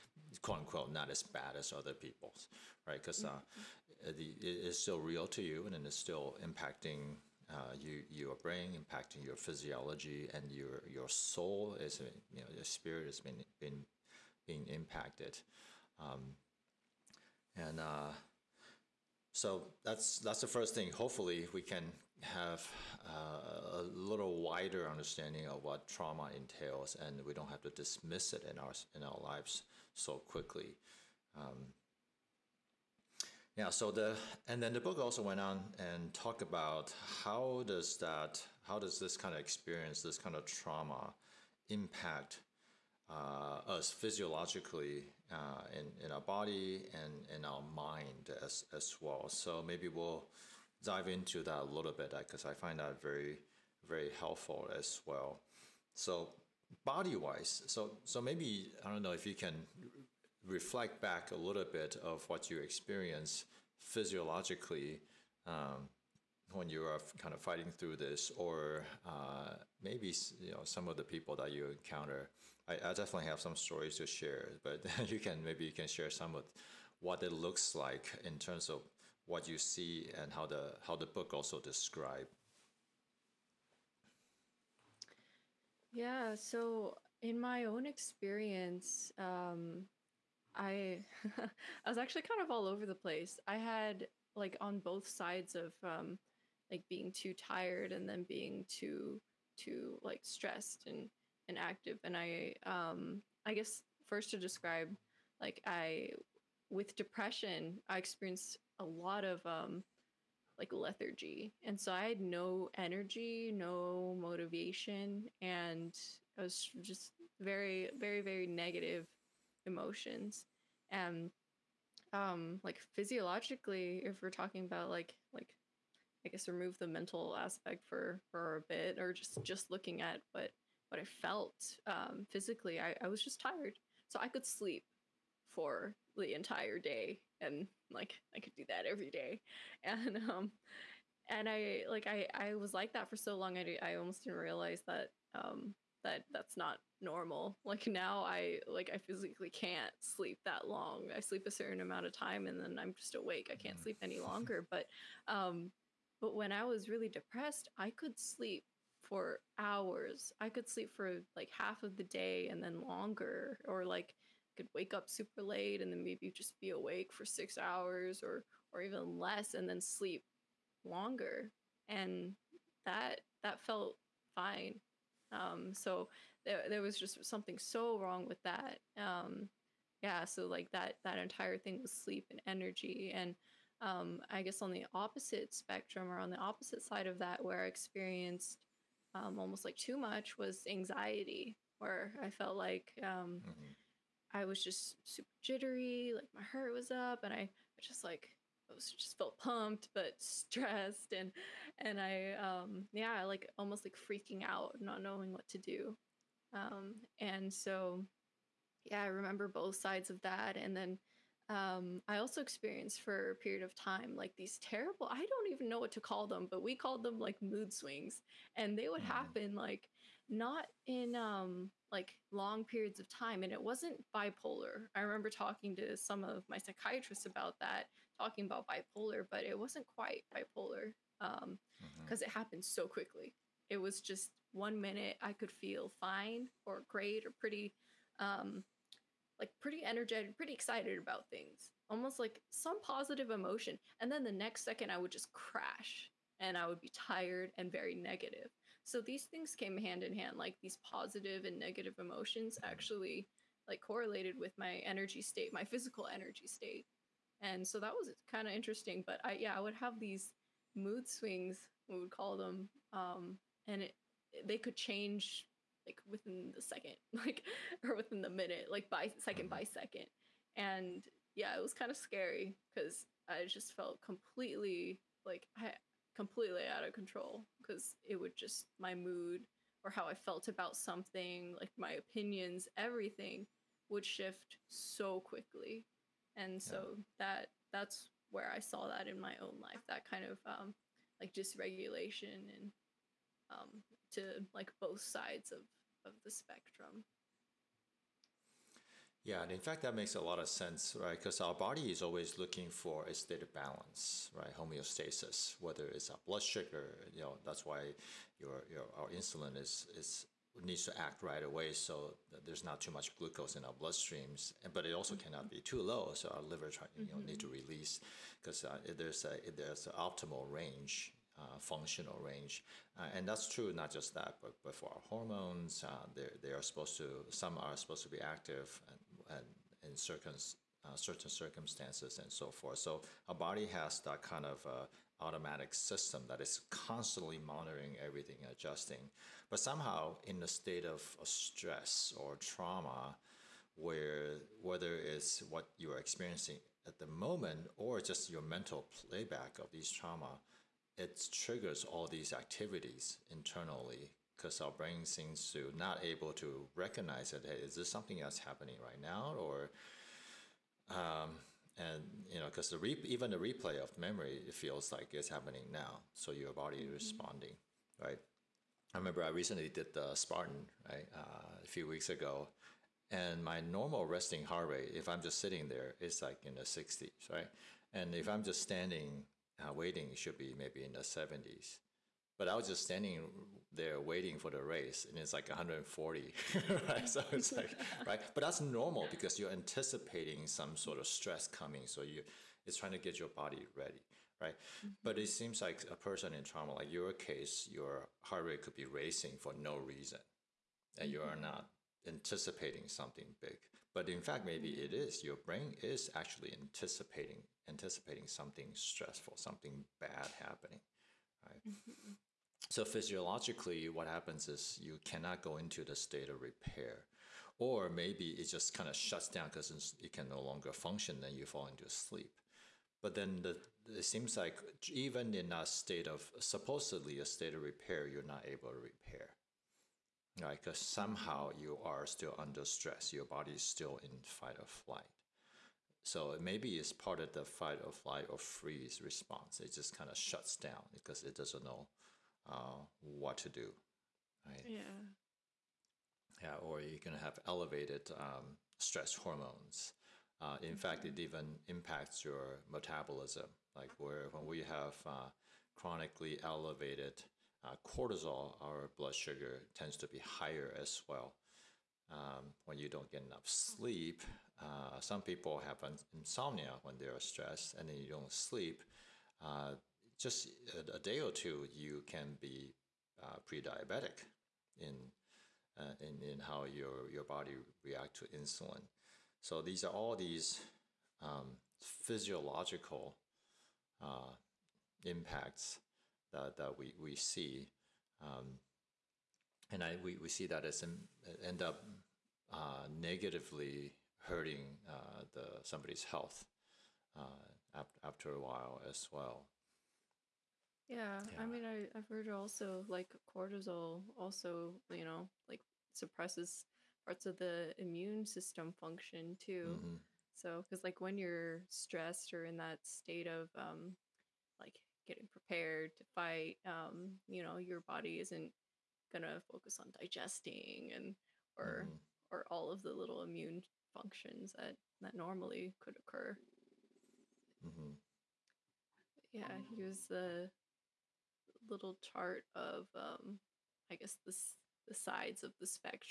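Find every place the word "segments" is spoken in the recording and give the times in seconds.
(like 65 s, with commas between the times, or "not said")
not said.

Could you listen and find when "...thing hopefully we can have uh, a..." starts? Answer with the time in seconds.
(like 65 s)
20 s.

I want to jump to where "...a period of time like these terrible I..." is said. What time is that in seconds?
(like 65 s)
213 s.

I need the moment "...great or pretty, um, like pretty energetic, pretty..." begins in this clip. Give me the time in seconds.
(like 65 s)
236 s.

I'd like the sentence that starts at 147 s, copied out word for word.
Like now I like I physically can't sleep that long.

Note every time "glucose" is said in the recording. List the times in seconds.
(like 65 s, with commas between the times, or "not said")
313 s.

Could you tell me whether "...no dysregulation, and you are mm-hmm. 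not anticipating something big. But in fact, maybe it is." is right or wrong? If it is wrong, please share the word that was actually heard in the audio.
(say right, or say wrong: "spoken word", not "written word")
wrong: "reason", not "dysregulation".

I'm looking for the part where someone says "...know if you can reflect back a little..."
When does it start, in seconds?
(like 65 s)
59 s.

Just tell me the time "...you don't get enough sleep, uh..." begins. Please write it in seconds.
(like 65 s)
462 s.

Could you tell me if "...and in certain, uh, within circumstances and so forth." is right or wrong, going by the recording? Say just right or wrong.
wrong.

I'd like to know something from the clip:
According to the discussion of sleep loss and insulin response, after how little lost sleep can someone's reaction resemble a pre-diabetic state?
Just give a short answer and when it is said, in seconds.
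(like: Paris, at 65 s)
a day or two, at 470 s.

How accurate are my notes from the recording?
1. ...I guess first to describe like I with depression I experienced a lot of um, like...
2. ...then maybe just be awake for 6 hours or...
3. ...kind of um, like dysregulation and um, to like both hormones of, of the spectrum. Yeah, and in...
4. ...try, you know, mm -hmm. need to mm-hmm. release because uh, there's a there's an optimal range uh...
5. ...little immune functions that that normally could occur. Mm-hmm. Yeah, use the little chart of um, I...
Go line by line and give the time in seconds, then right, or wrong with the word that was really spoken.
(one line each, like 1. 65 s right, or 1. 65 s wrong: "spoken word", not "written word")
1. 103 s right
2. 165 s right
3. 290 s wrong: "sides", not "hormones"
4. 316 s right
5. 522 s right.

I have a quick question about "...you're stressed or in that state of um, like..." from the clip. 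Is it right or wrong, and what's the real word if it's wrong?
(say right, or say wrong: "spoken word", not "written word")
right.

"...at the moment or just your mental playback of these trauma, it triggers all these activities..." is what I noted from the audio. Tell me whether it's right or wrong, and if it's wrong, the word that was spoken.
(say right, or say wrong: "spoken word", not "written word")
right.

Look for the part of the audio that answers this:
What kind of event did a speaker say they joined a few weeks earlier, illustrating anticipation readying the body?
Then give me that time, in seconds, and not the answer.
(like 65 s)
370 s.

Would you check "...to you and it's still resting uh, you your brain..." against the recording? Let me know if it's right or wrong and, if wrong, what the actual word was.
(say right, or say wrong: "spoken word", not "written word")
wrong: "impacting", not "resting".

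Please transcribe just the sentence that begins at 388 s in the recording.
But that's normal because you're anticipating some sort of stress coming, so you, it's trying to get your body ready, right?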